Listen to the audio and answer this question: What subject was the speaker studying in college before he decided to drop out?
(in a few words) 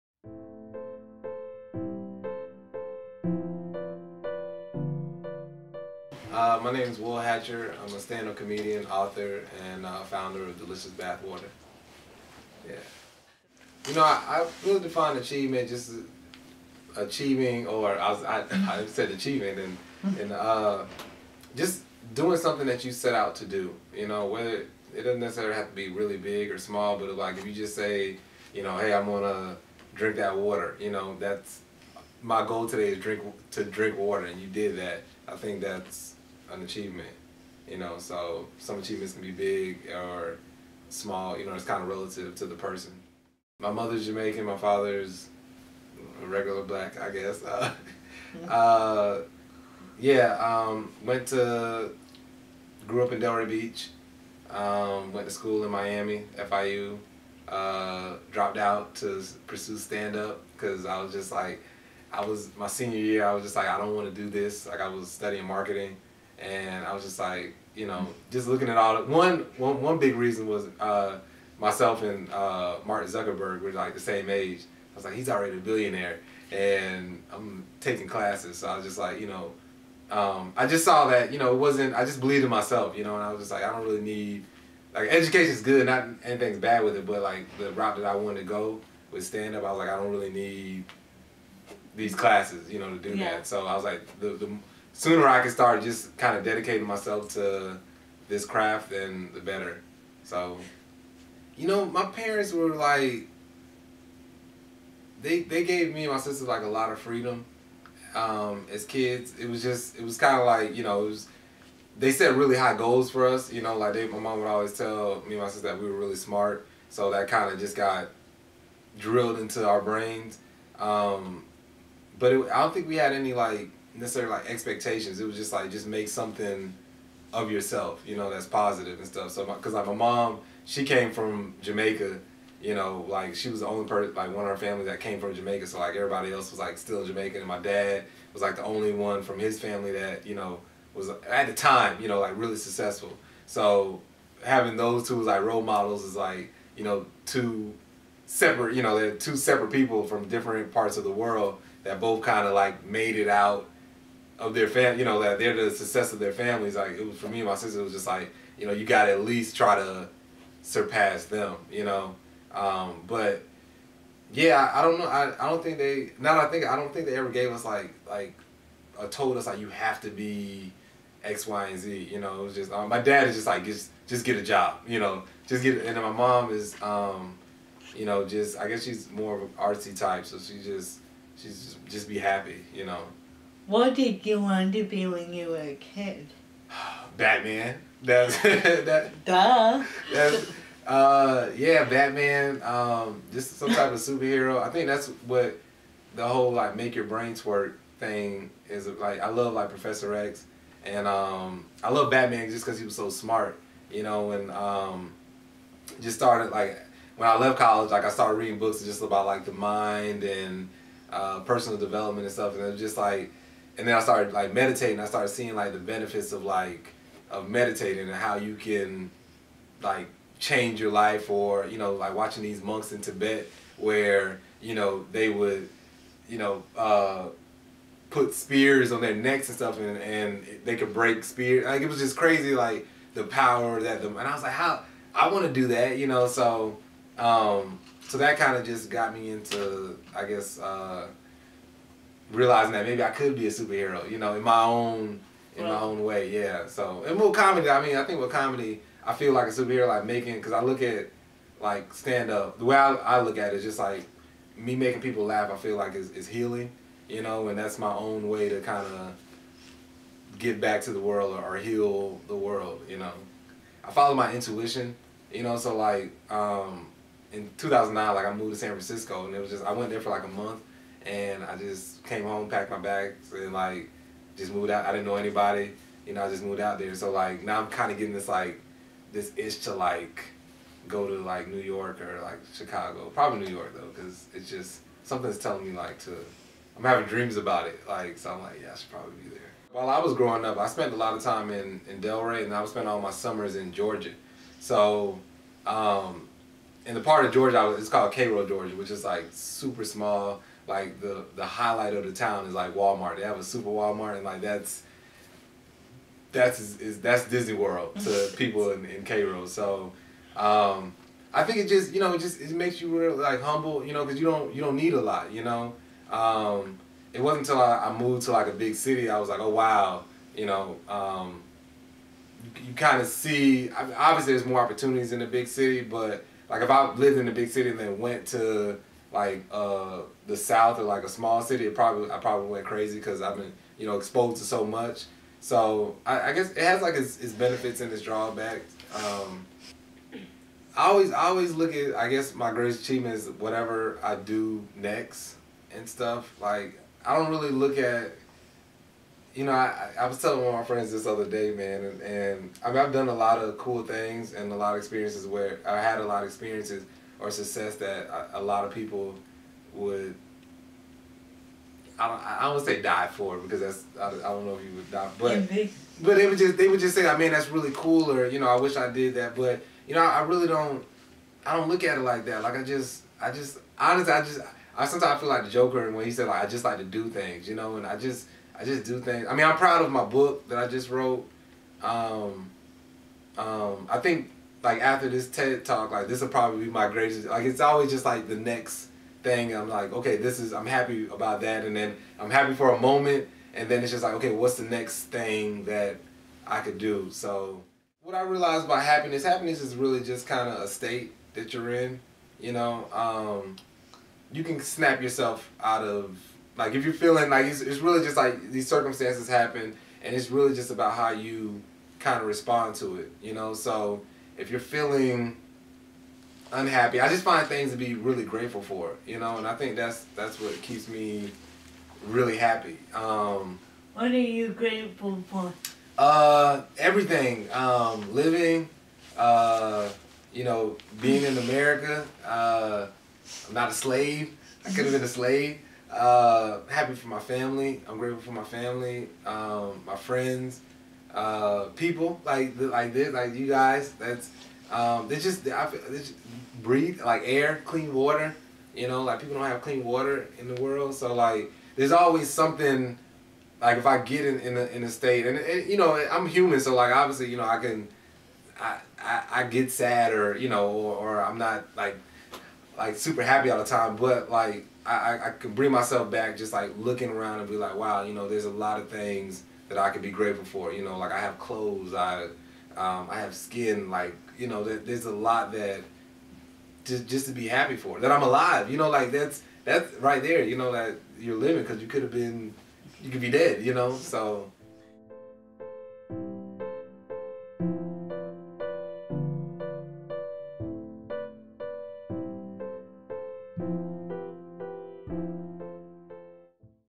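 Marketing.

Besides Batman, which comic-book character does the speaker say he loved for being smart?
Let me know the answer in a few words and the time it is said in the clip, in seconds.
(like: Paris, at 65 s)
Professor X, at 199 s.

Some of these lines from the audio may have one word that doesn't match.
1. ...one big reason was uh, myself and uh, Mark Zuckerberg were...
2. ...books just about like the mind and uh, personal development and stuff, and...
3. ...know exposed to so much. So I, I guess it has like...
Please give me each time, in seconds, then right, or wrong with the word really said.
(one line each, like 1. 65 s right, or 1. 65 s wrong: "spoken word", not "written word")
1. 69 s right
2. 208 s right
3. 333 s right.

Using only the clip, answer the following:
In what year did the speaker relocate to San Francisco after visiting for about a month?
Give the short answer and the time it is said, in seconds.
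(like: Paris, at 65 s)
2009, at 267 s.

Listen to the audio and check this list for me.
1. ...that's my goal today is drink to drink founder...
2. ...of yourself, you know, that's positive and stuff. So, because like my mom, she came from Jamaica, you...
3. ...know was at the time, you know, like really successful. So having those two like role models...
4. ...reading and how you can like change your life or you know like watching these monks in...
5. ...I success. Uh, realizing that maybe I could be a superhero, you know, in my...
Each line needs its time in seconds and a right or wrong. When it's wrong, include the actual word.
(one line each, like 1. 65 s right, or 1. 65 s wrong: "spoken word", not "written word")
1. 31 s wrong: "water", not "founder"
2. 127 s right
3. 140 s right
4. 217 s wrong: "meditating", not "reading"
5. 240 s wrong: "guess", not "success".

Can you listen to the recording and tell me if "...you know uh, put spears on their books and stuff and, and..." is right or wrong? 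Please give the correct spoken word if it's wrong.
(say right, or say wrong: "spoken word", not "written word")
wrong: "necks", not "books".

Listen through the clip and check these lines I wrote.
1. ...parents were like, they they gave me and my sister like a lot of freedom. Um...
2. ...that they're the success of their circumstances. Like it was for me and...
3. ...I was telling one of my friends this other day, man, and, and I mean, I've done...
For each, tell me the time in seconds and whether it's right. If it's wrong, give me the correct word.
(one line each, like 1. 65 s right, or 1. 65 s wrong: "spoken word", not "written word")
1. 102 s right
2. 155 s wrong: "families", not "circumstances"
3. 349 s right.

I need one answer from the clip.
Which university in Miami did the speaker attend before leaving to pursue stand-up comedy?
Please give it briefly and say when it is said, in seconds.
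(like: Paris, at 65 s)
FIU, at 56 s.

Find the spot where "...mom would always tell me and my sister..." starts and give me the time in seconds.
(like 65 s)
114 s.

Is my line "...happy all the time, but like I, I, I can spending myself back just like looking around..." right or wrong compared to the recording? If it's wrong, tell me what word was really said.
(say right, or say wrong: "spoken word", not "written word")
wrong: "bring", not "spending".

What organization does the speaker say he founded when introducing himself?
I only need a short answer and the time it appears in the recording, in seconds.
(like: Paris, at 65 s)
Delicious Bathwater, at 10 s.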